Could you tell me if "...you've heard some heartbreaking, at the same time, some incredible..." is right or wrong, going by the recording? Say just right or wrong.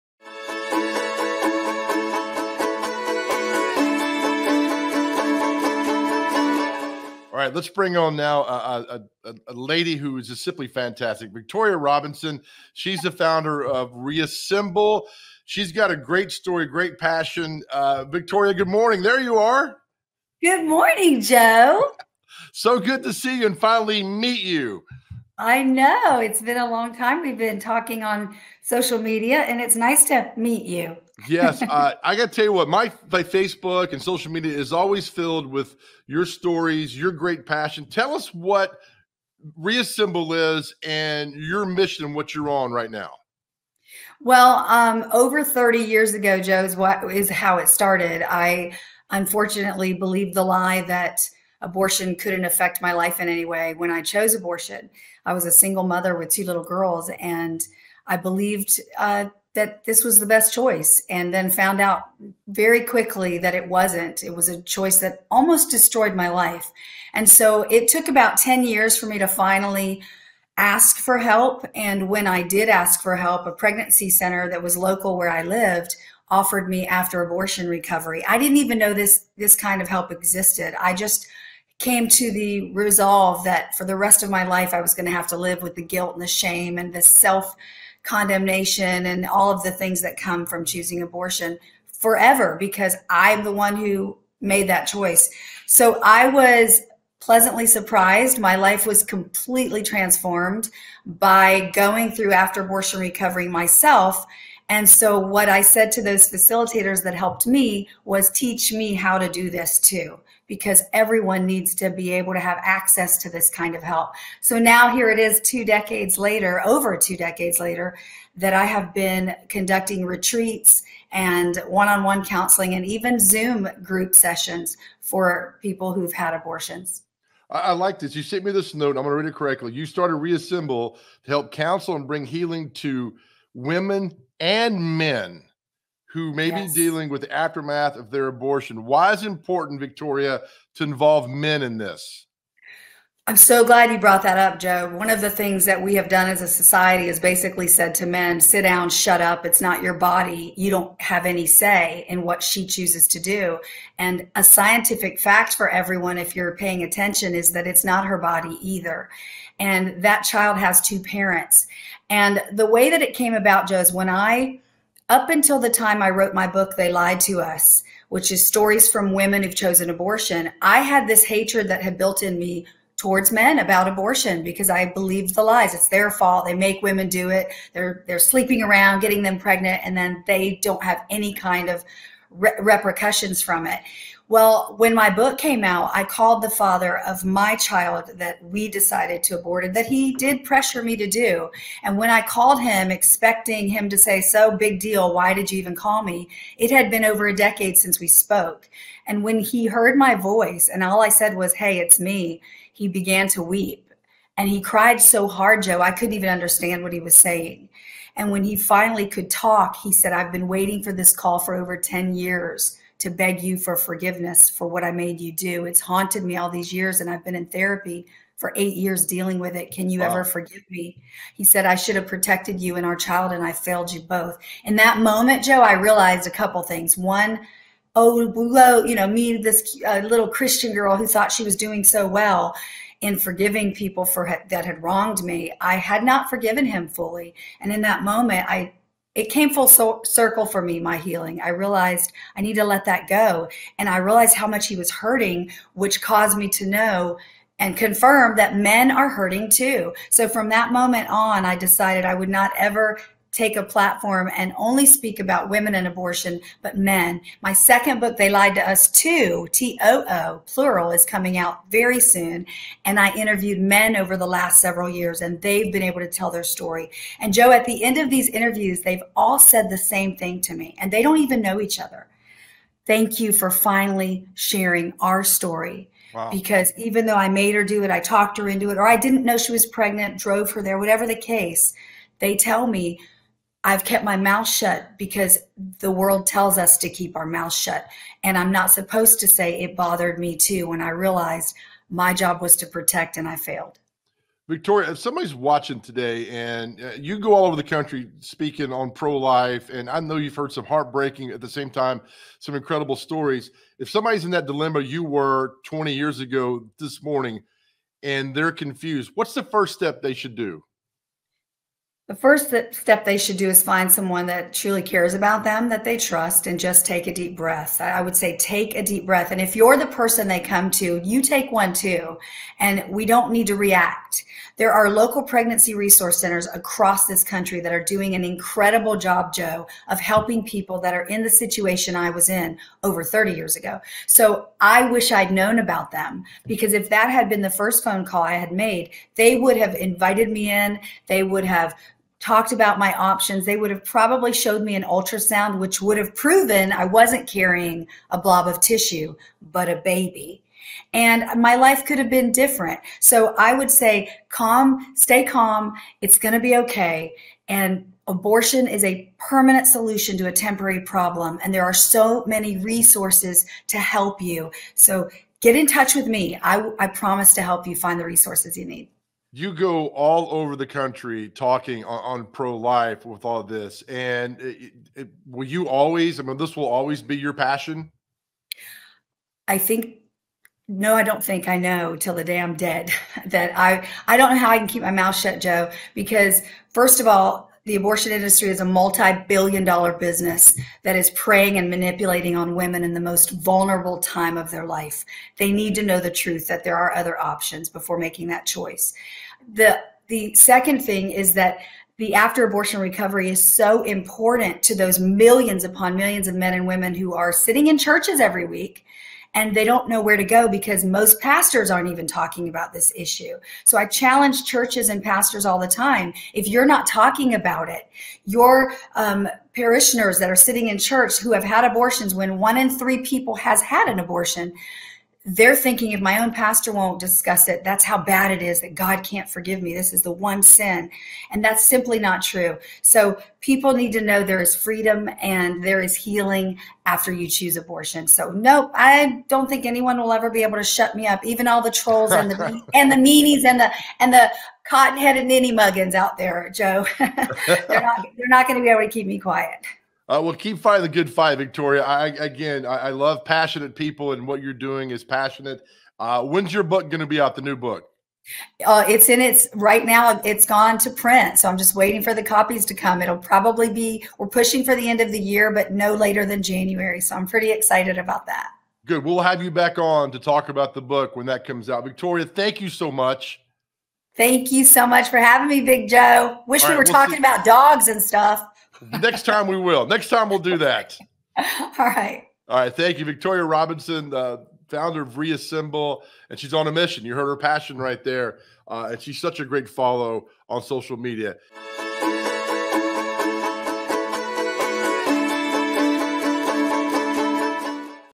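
right.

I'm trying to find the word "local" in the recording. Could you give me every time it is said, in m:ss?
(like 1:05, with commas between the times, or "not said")
1:14, 5:24.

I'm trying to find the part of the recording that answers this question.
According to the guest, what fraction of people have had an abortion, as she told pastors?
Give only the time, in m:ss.
7:02.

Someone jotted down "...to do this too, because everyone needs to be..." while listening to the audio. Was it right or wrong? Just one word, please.
right.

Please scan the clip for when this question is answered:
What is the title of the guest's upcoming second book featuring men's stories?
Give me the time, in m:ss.
4:18.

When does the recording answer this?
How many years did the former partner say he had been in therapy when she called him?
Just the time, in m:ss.
3:38.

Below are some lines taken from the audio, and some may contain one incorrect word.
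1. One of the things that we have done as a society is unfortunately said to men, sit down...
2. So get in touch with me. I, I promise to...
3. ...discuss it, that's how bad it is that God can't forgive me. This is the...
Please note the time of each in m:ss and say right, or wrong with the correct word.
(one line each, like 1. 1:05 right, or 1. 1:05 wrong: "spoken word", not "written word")
1. 2:24 wrong: "basically", not "unfortunately"
2. 6:04 right
3. 7:06 right.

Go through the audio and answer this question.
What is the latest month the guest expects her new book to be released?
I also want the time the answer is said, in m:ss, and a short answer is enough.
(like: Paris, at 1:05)
January, at 7:46.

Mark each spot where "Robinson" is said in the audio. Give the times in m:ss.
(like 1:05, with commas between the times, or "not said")
0:11, 8:03.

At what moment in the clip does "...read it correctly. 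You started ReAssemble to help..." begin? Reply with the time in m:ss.
2:09.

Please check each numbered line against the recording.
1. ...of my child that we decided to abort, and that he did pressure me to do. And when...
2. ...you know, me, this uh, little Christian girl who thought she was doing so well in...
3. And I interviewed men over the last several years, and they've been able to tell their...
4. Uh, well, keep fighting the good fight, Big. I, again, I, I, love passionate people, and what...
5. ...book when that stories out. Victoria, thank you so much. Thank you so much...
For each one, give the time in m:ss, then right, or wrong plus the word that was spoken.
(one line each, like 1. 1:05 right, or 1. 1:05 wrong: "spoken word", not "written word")
1. 3:06 right
2. 3:48 right
3. 4:22 right
4. 7:30 wrong: "Victoria", not "Big"
5. 7:50 wrong: "comes", not "stories".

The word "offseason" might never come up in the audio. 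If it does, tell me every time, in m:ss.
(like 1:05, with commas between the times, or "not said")
not said.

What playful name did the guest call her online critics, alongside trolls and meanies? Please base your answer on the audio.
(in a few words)
cotton-headed ninny muggins.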